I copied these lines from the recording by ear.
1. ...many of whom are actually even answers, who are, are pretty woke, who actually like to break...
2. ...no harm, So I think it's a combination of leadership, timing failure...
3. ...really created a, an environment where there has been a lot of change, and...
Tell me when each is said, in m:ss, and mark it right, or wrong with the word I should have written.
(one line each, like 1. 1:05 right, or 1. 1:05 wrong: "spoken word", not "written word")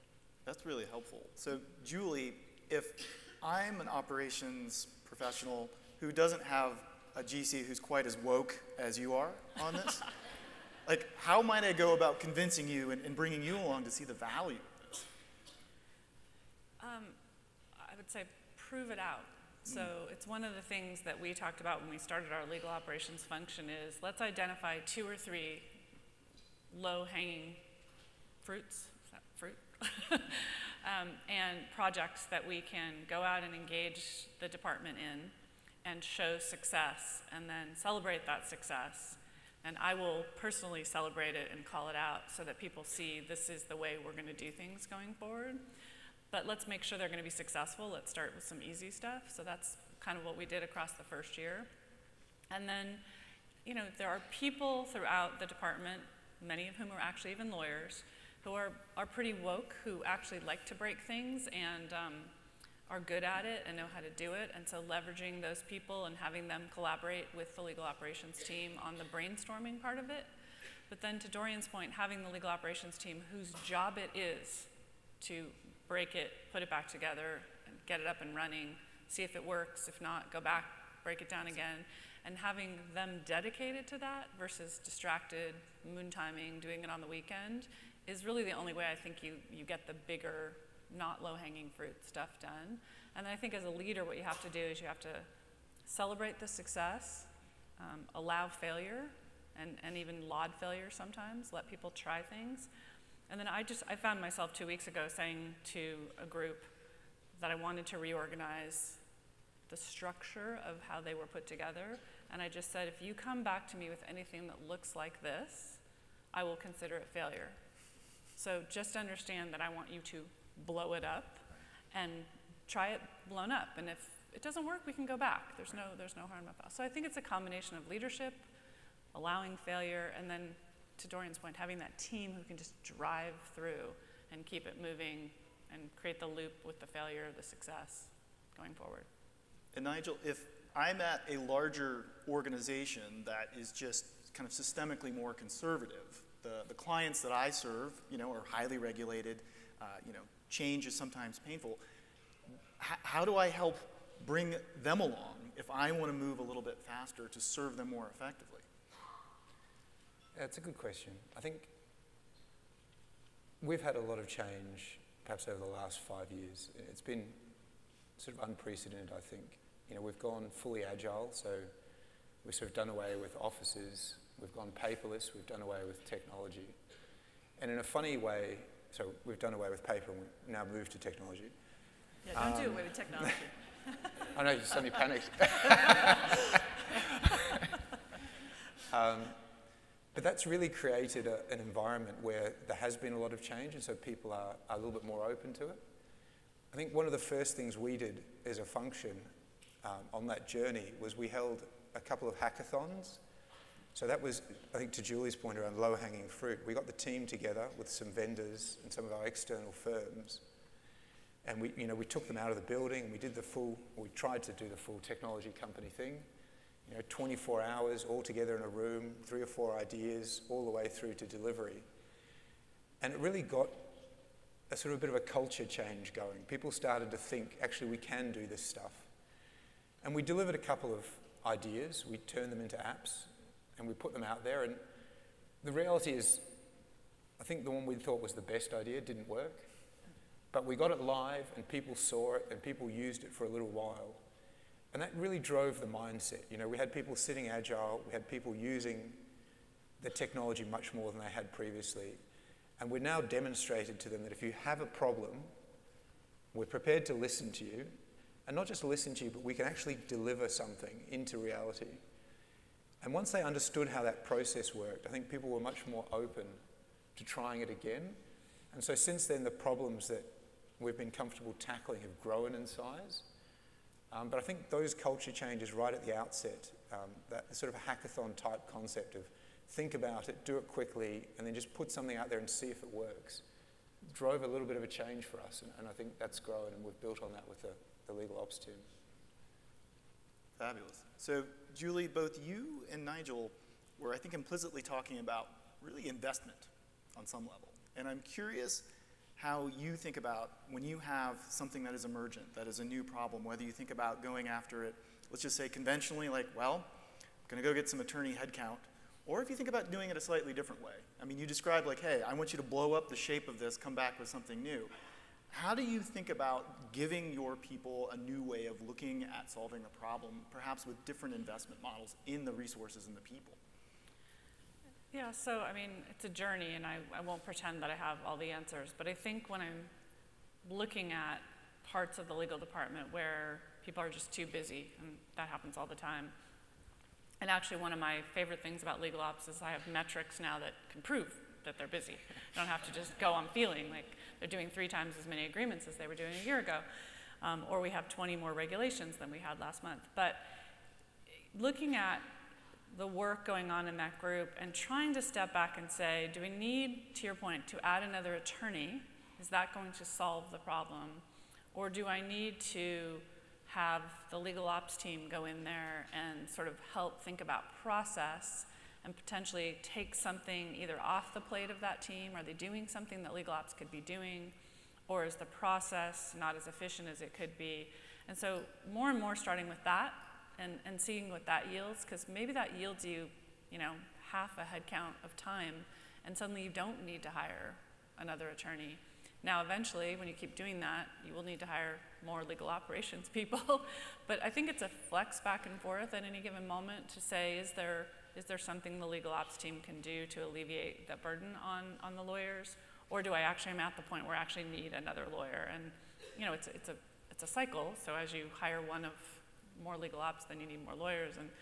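1. 0:56 wrong: "lawyers", not "answers"
2. 2:06 wrong: "allowing", not "timing"
3. 3:10 right.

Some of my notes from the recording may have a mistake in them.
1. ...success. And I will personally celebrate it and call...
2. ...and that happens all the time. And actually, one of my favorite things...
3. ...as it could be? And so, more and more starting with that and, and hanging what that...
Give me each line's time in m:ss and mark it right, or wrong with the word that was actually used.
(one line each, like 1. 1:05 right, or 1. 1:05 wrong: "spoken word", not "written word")
1. 0:38 right
2. 5:34 right
3. 6:17 wrong: "seeing", not "hanging".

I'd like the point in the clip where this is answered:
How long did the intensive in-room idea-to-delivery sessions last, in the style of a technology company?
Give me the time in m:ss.
3:37.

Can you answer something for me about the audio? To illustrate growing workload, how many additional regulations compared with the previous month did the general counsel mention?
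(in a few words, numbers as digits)
20.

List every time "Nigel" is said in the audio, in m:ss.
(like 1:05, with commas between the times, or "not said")
2:19, 4:53.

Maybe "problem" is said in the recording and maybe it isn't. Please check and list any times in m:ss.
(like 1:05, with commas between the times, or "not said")
4:14, 4:29, 5:03, 5:20, 6:00.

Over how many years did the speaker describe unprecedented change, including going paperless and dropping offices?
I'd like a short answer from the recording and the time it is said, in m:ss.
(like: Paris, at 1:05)
5 years, at 2:45.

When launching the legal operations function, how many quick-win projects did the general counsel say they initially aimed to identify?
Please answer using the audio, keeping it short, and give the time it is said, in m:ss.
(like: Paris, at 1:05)
2 or 3, at 0:24.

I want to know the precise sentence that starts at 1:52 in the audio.
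And I just said, if you come back to me with anything that looks like this, I will consider it failure.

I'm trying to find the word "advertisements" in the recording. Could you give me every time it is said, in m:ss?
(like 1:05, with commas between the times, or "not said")
not said.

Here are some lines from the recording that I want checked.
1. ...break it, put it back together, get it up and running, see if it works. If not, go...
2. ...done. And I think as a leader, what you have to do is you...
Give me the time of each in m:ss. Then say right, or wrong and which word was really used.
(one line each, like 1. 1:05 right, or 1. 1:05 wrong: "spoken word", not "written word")
1. 1:15 right
2. 1:32 right.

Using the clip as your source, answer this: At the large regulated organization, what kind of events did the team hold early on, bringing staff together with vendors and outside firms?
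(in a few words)
Hackathons.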